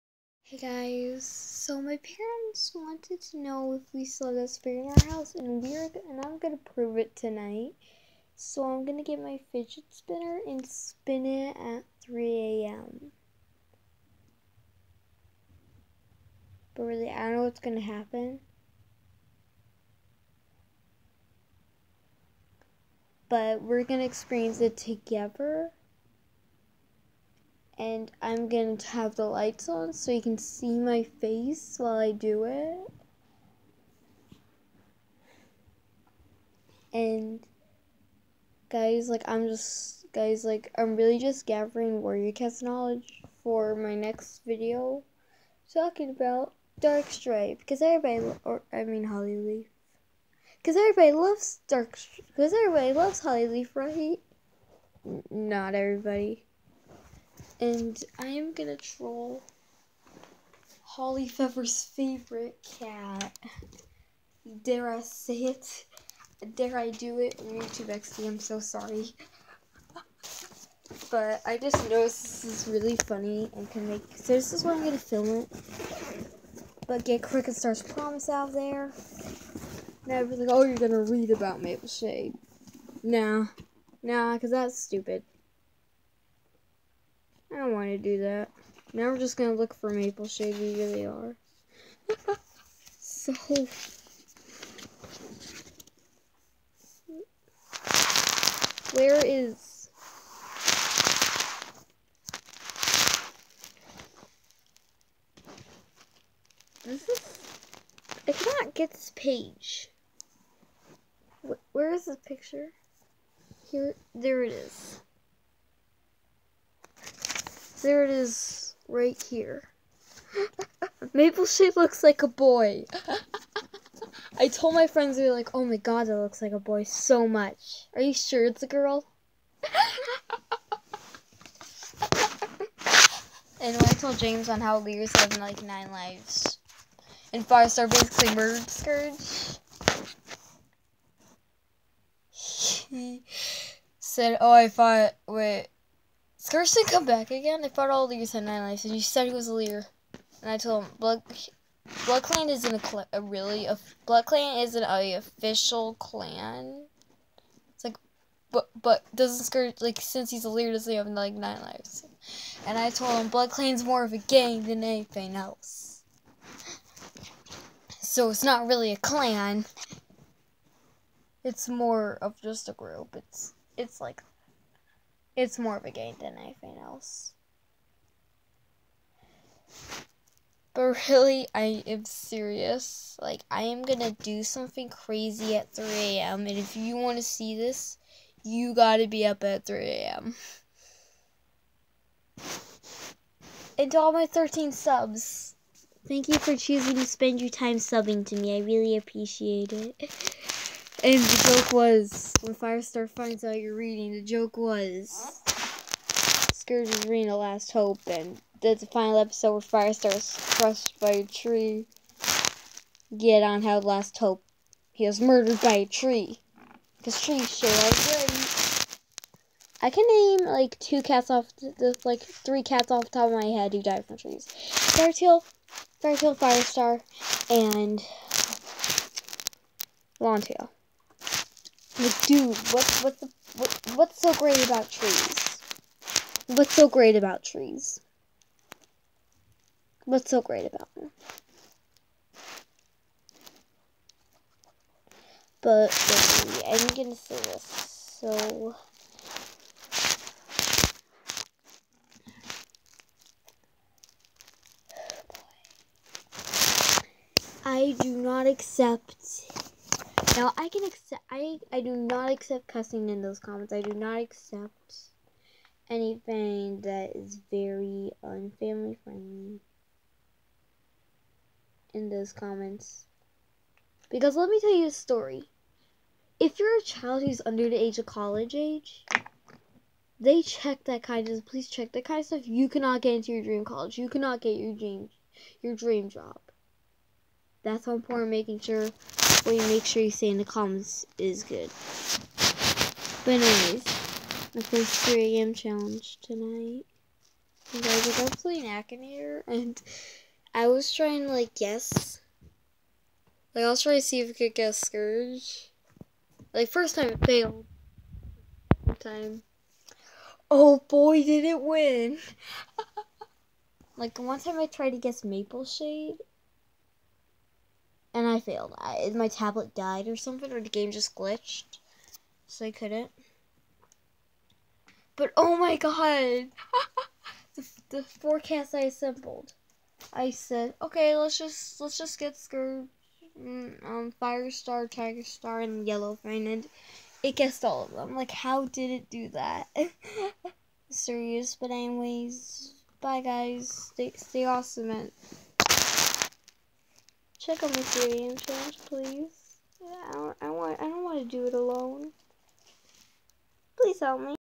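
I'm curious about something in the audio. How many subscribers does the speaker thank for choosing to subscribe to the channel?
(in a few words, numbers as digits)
13.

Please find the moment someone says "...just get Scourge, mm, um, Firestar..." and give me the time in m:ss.
5:31.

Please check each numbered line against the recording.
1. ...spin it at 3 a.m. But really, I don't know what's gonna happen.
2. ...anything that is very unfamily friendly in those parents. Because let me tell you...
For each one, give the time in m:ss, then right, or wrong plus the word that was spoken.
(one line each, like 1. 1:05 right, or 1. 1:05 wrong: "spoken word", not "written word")
1. 0:10 right
2. 4:25 wrong: "comments", not "parents".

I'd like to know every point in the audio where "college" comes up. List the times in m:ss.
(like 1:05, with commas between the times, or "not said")
4:38, 4:43.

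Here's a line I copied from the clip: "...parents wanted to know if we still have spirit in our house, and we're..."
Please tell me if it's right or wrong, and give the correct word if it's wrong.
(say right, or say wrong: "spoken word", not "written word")
right.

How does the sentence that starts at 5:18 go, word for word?
I, my tablet died or something, or the game just glitched.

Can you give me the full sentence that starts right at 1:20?
Now like, oh, you're gonna read about Mapleshade.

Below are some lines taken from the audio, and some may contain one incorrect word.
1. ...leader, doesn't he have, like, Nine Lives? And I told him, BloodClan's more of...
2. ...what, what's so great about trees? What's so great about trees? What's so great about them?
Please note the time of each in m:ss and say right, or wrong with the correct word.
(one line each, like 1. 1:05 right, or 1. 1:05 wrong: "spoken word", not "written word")
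1. 2:40 right
2. 3:53 right.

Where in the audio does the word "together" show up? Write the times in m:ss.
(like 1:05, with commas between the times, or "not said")
0:24.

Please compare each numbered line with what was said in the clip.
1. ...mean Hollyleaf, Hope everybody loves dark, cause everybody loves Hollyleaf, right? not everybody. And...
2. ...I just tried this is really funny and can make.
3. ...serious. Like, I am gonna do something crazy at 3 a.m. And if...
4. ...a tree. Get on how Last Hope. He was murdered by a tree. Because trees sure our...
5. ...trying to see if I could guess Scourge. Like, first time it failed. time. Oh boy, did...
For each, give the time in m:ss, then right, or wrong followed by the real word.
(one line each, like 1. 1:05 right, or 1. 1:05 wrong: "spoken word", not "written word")
1. 0:48 wrong: "Cause", not "Hope"
2. 1:11 wrong: "noticed", not "tried"
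3. 3:02 right
4. 3:31 right
5. 5:03 right.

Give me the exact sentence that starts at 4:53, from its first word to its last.
But anyways, my first 3 a.m.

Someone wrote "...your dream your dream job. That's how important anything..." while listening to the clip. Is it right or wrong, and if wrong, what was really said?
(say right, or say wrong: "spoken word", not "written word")
wrong: "making", not "anything".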